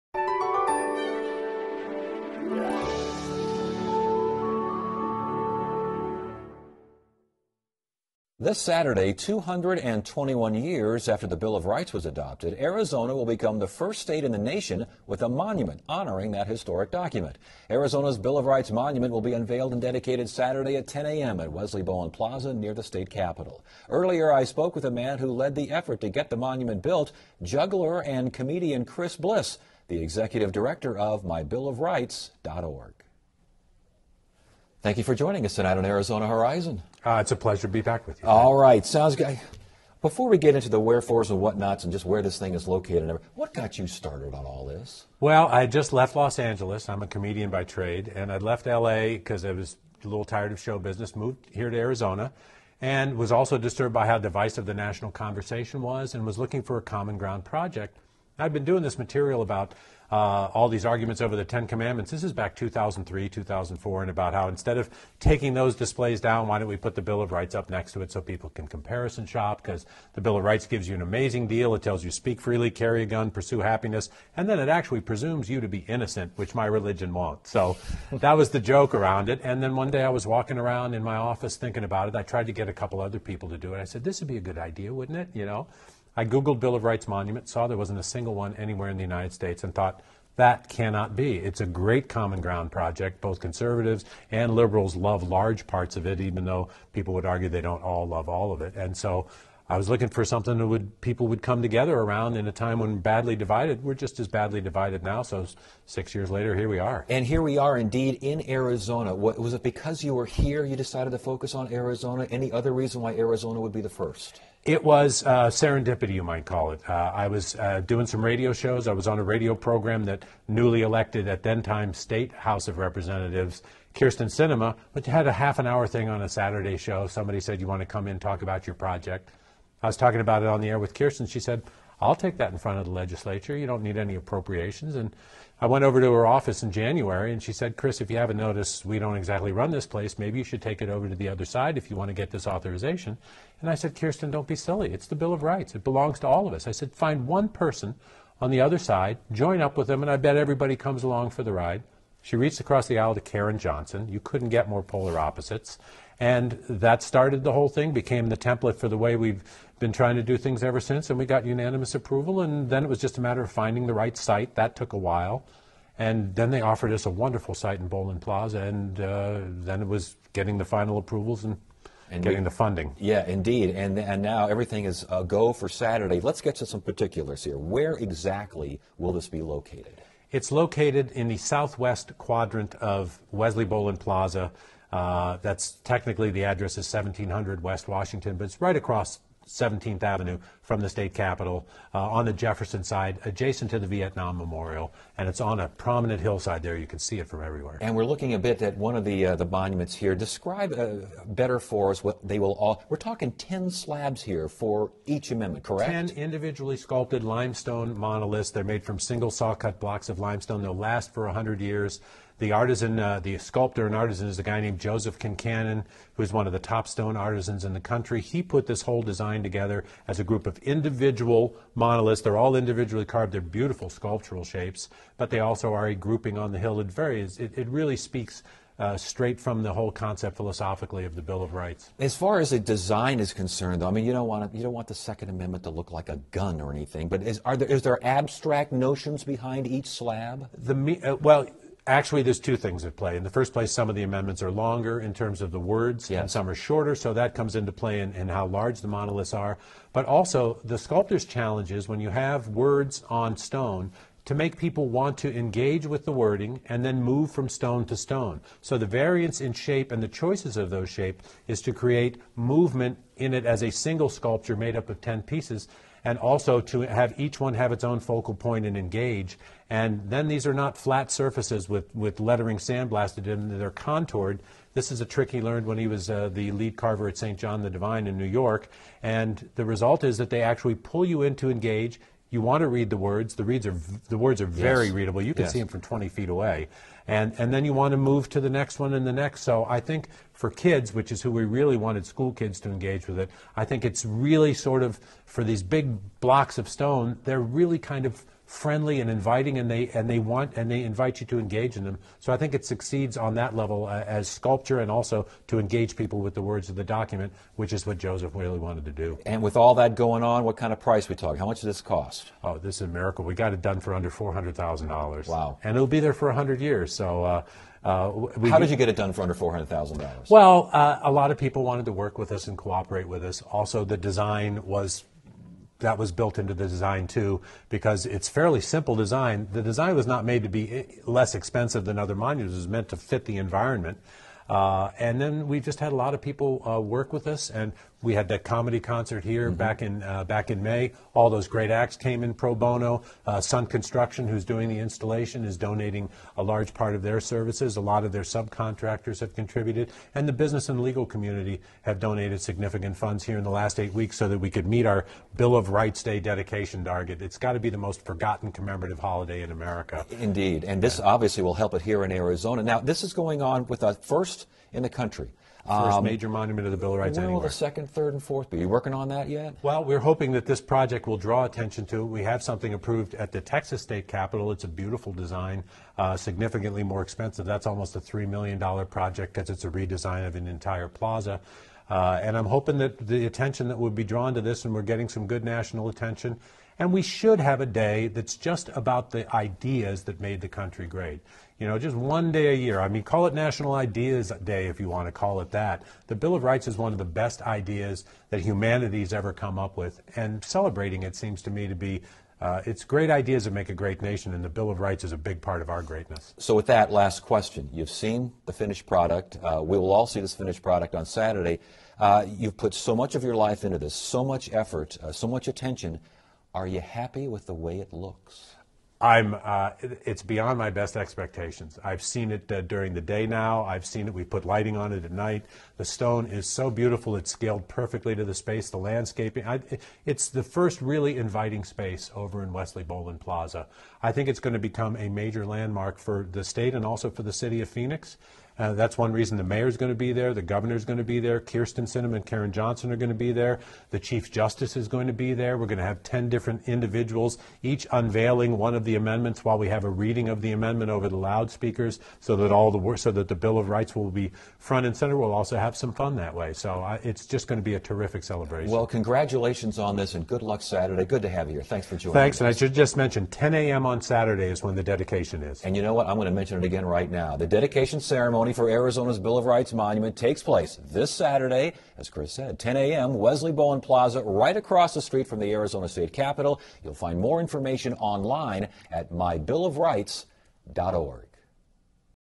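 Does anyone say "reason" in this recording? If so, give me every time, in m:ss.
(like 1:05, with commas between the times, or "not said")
1:52, 7:19.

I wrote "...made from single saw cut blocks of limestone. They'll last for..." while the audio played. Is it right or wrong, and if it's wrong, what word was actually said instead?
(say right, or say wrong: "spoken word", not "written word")
right.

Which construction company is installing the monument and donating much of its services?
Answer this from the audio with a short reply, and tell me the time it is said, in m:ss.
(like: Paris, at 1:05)
Sundt Construction, at 5:43.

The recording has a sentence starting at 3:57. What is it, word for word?
But is, are there is there abstract notions behind each slab?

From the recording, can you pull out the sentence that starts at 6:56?
Are you happy with the way it looks?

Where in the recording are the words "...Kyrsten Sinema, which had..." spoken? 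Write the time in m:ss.
2:03.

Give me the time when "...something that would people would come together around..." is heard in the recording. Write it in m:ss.
1:40.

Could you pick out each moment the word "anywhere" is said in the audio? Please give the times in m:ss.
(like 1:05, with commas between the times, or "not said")
1:28, 6:07.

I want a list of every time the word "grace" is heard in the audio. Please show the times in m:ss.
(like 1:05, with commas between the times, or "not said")
not said.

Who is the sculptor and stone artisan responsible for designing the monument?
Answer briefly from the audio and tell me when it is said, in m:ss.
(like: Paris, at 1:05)
Joseph Kincannon, at 3:34.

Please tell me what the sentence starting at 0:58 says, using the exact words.
I've been doing this material about uh, all these arguments over the Ten Commandments.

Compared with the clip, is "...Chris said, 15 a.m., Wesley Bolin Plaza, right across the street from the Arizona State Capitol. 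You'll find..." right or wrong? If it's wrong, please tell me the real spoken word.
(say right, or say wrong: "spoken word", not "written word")
wrong: "10", not "15".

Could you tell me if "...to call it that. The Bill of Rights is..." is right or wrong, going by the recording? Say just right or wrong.
right.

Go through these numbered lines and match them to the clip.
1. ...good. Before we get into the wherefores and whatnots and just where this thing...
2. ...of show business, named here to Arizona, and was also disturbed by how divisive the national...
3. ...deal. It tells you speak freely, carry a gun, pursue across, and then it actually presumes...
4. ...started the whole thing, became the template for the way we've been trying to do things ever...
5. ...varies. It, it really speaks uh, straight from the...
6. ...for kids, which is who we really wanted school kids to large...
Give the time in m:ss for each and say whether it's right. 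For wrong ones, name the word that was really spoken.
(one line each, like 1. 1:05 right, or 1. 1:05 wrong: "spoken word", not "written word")
1. 0:39 right
2. 0:50 wrong: "moved", not "named"
3. 1:11 wrong: "happiness", not "across"
4. 2:37 right
5. 3:46 right
6. 4:50 wrong: "engage", not "large".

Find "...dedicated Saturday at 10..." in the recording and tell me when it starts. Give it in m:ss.
0:19.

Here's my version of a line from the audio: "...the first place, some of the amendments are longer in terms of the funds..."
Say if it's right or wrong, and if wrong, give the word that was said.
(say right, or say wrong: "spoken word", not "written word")
wrong: "words", not "funds".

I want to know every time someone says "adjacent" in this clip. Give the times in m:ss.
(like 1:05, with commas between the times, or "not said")
3:13.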